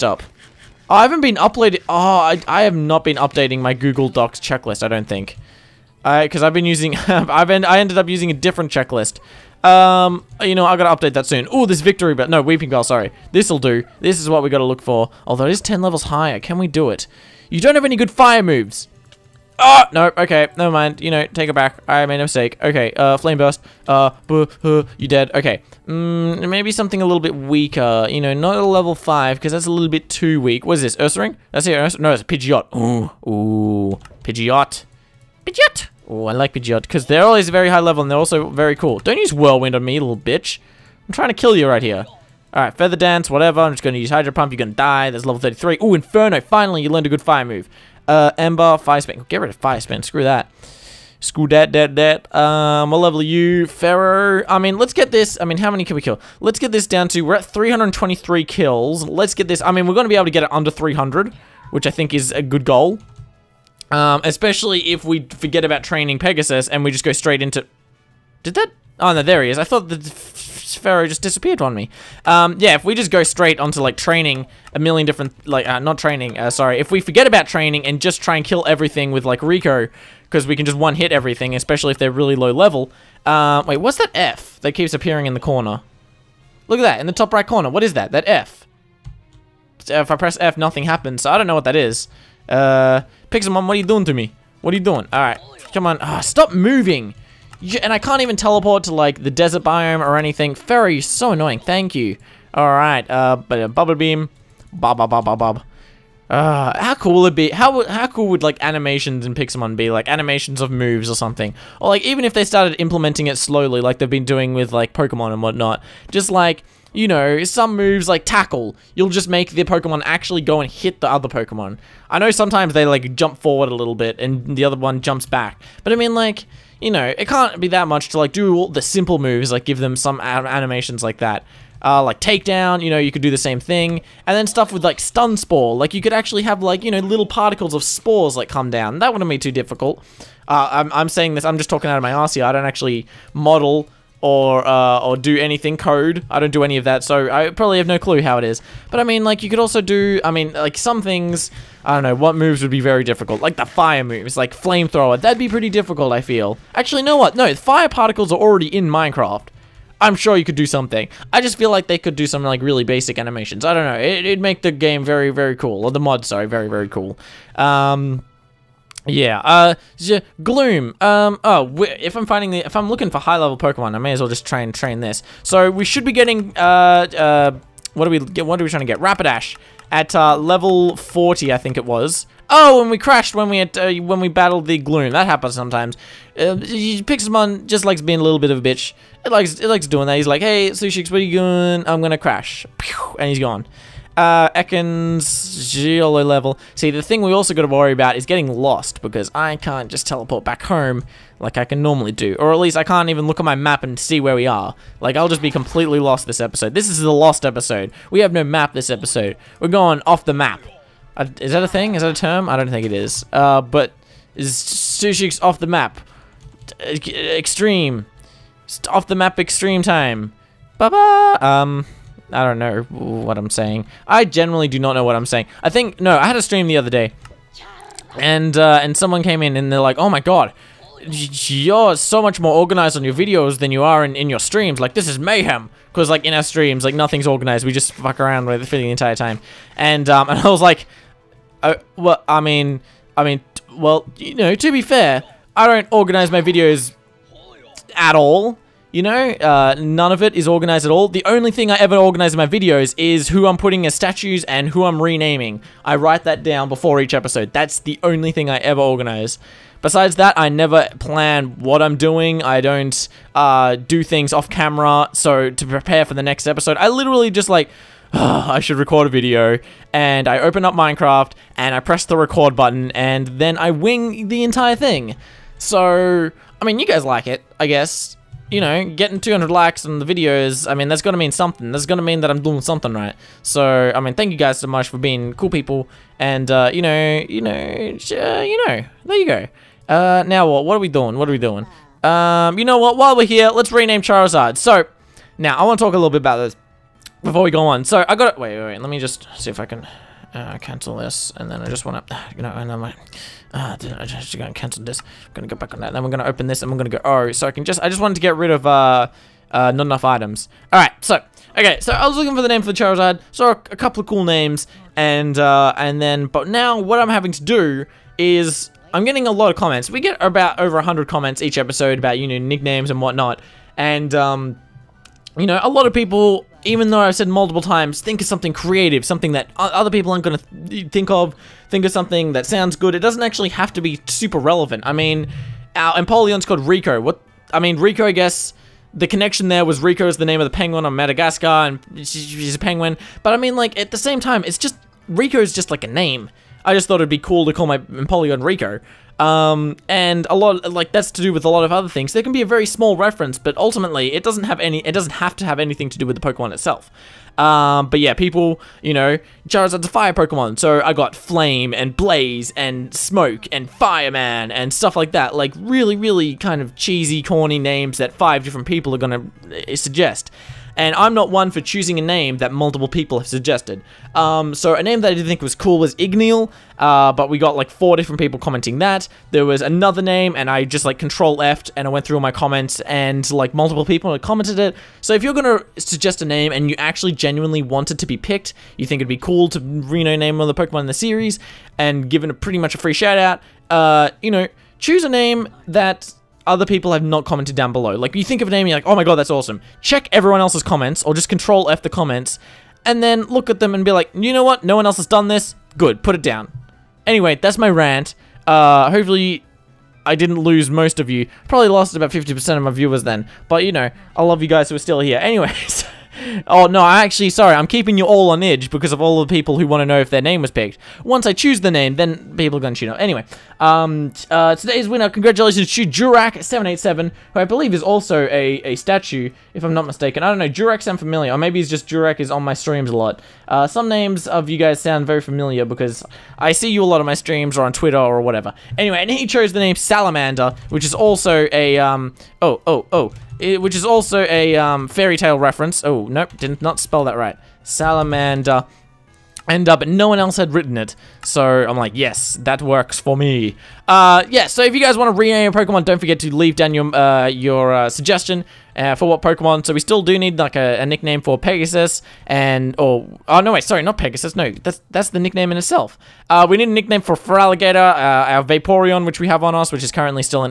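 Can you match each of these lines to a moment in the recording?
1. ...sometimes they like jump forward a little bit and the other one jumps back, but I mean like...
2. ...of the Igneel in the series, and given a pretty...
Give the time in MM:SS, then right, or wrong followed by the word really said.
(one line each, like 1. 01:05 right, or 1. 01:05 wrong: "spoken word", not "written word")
1. 02:02 right
2. 06:30 wrong: "Pokemon", not "Igneel".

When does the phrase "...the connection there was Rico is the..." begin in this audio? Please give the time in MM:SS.
05:38.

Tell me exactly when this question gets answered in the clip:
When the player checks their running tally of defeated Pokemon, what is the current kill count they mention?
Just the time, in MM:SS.
00:57.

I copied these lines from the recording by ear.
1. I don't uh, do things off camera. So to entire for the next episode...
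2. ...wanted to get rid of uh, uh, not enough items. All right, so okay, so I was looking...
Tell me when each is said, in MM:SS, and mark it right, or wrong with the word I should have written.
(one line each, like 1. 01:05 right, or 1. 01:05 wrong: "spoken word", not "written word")
1. 04:22 wrong: "prepare", not "entire"
2. 05:08 right.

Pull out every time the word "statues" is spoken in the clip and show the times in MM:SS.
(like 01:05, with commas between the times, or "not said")
04:13, 07:08.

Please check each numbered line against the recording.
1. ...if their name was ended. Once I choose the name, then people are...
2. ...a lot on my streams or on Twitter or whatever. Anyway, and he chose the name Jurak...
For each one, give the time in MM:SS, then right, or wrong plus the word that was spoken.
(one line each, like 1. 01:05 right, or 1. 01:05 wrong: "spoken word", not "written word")
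1. 06:59 wrong: "picked", not "ended"
2. 07:16 wrong: "Salamander", not "Jurak".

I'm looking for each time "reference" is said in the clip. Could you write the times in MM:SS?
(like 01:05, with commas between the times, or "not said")
05:52, 07:25.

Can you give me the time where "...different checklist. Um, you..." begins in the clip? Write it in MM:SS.
00:08.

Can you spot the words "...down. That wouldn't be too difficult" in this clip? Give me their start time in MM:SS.
02:18.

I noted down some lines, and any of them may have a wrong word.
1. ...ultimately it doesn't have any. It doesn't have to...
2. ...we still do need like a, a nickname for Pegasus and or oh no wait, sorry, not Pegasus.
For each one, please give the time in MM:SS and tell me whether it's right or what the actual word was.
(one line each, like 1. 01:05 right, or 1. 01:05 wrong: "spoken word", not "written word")
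1. 05:53 right
2. 07:39 right.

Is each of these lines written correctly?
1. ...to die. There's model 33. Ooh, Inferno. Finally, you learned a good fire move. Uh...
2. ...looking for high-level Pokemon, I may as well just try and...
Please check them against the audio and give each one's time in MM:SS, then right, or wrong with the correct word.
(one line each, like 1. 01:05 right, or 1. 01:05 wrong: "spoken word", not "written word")
1. 00:44 wrong: "level", not "model"
2. 02:52 right.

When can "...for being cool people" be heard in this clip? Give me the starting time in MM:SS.
04:44.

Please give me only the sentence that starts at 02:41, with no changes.
I just feel like they could do some like really basic animations.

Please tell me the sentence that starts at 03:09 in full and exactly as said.
It likes, it likes doing that, he's like, hey, Sushix, what are you doing?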